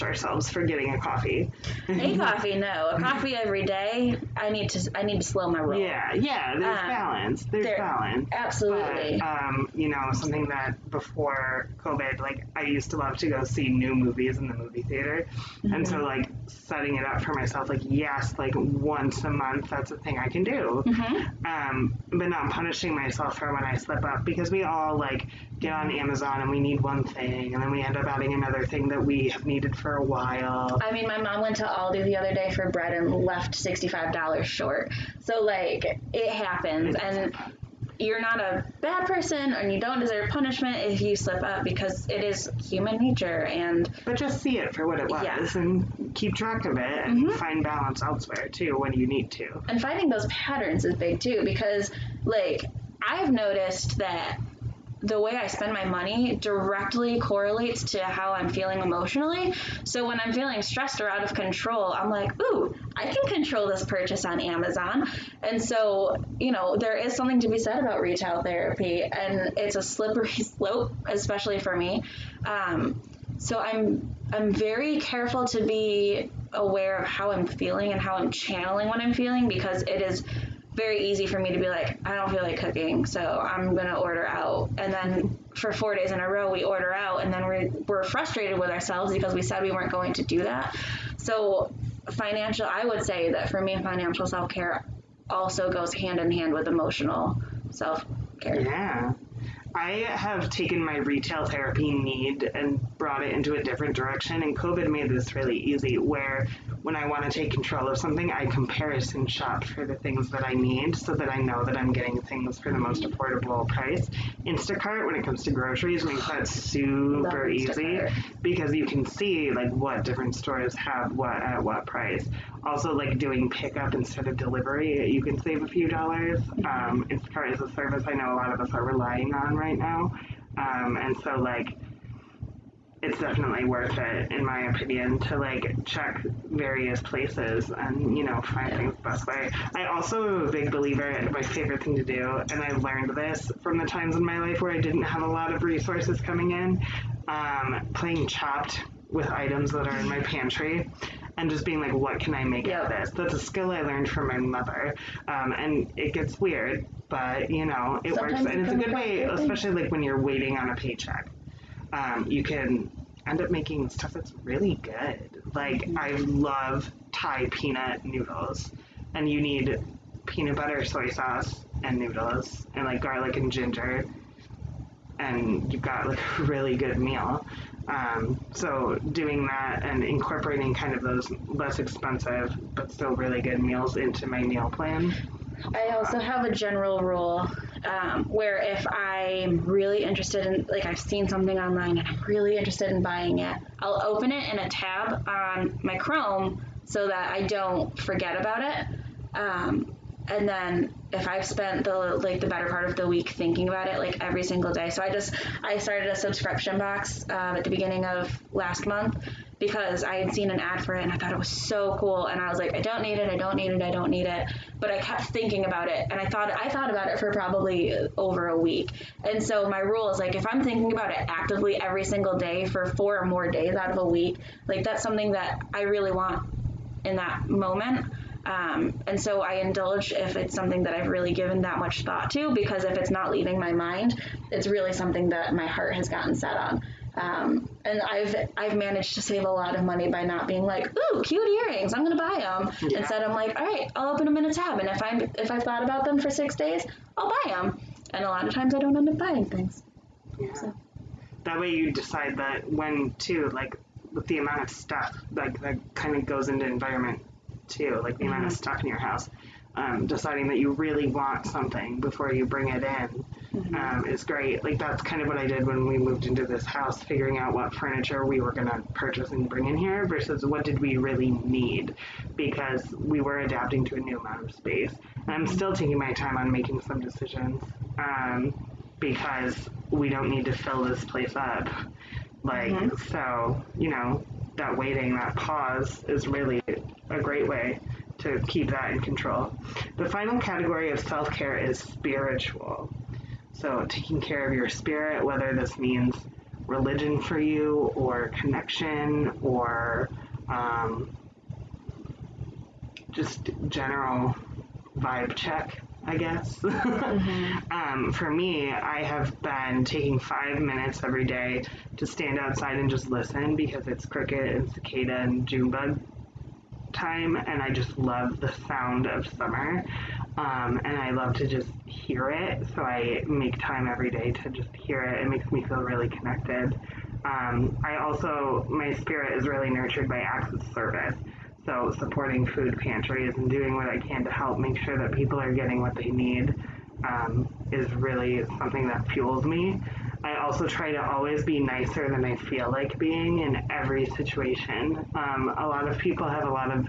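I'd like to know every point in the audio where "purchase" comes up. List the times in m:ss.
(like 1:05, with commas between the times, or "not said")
1:03, 4:28.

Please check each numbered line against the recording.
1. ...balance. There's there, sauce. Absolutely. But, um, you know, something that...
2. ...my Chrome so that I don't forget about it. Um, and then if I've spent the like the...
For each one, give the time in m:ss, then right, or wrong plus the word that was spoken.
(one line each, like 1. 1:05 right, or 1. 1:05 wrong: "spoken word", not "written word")
1. 0:06 wrong: "balance", not "sauce"
2. 3:15 right.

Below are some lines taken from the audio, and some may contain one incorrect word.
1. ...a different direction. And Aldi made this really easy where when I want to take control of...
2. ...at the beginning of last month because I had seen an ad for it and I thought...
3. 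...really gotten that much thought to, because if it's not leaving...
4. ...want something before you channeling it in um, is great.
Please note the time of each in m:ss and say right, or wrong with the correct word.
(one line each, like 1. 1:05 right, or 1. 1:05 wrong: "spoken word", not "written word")
1. 1:43 wrong: "COVID", not "Aldi"
2. 3:27 right
3. 3:51 wrong: "given", not "gotten"
4. 4:21 wrong: "bring", not "channeling".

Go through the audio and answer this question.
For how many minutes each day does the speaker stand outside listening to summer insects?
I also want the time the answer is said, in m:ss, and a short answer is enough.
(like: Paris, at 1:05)
5, at 5:10.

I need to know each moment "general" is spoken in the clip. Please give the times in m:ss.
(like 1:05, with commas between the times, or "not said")
3:06, 5:03.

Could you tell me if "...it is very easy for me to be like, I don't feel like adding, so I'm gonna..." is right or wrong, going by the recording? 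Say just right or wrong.
wrong.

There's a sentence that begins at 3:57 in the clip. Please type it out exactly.
Um, and I've I've managed to save a lot of money by not being like, ooh, cute earrings, I'm gonna buy them.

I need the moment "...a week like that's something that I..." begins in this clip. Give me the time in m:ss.
3:43.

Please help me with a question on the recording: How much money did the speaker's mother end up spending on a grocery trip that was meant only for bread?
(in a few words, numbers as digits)
$65.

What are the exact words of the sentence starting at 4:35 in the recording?
And I'm still taking my time on making some decisions um, because we don't need to fill this place up.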